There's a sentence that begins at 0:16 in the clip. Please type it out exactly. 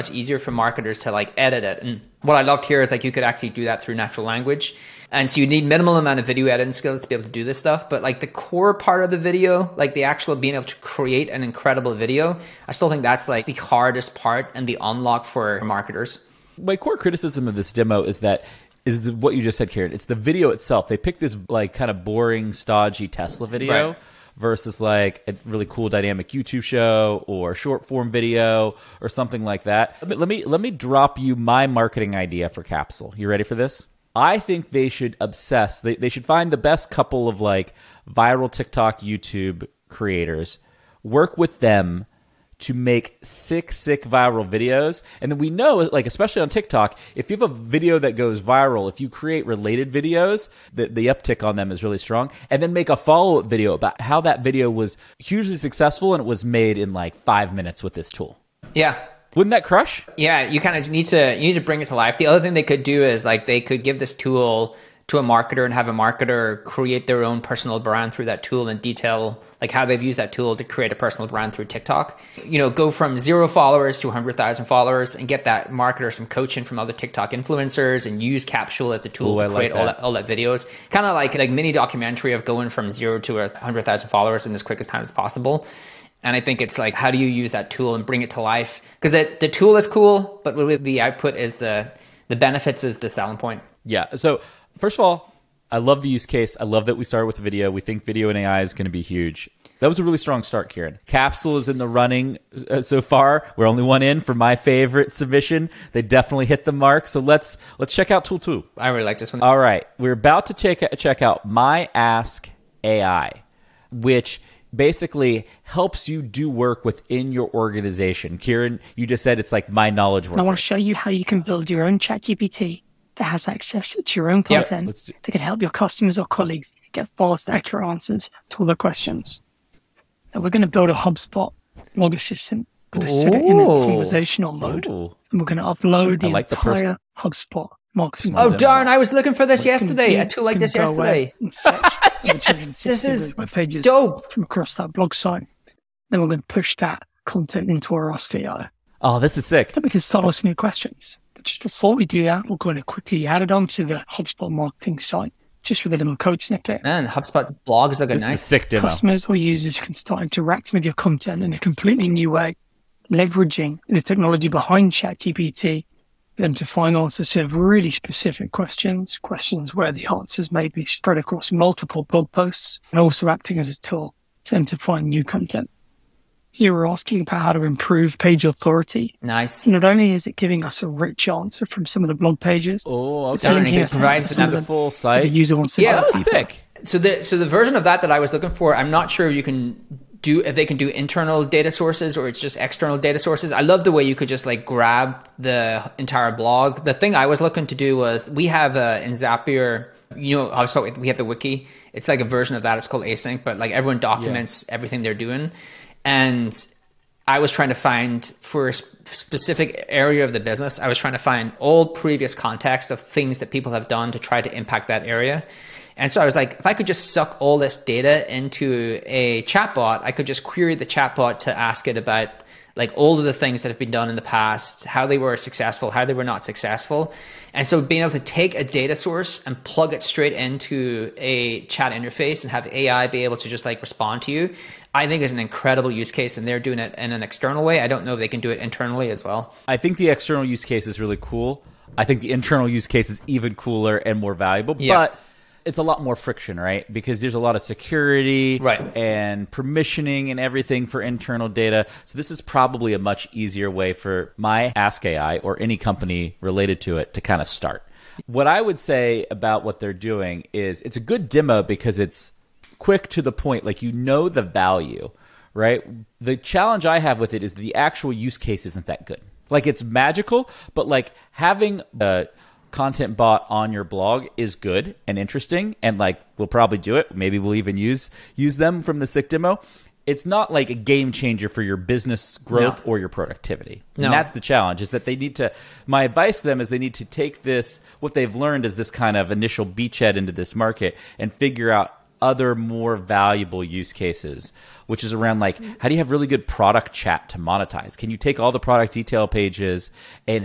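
My core criticism of this demo is that is what you just said, Karen.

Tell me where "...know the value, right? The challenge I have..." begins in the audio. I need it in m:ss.
4:23.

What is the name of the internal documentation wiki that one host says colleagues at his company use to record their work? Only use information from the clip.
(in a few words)
async.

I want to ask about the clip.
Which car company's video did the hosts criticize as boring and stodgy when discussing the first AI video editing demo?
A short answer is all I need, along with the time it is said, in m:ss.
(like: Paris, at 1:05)
Tesla, at 0:23.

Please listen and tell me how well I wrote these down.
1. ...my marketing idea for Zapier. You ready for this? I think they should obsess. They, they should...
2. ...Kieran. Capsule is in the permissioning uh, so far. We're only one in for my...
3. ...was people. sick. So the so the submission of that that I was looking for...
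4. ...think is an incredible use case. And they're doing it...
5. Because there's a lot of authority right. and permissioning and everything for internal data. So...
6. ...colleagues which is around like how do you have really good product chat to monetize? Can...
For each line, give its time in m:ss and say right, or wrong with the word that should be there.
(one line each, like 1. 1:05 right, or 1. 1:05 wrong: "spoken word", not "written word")
1. 0:31 wrong: "Capsule", not "Zapier"
2. 1:40 wrong: "running", not "permissioning"
3. 3:06 wrong: "version", not "submission"
4. 3:55 right
5. 4:06 wrong: "security", not "authority"
6. 4:53 wrong: "cases", not "colleagues".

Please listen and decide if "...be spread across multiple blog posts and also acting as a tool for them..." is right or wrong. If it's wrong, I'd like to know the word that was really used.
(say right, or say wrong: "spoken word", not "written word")
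right.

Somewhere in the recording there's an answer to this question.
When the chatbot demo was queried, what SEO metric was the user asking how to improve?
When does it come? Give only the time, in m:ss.
2:58.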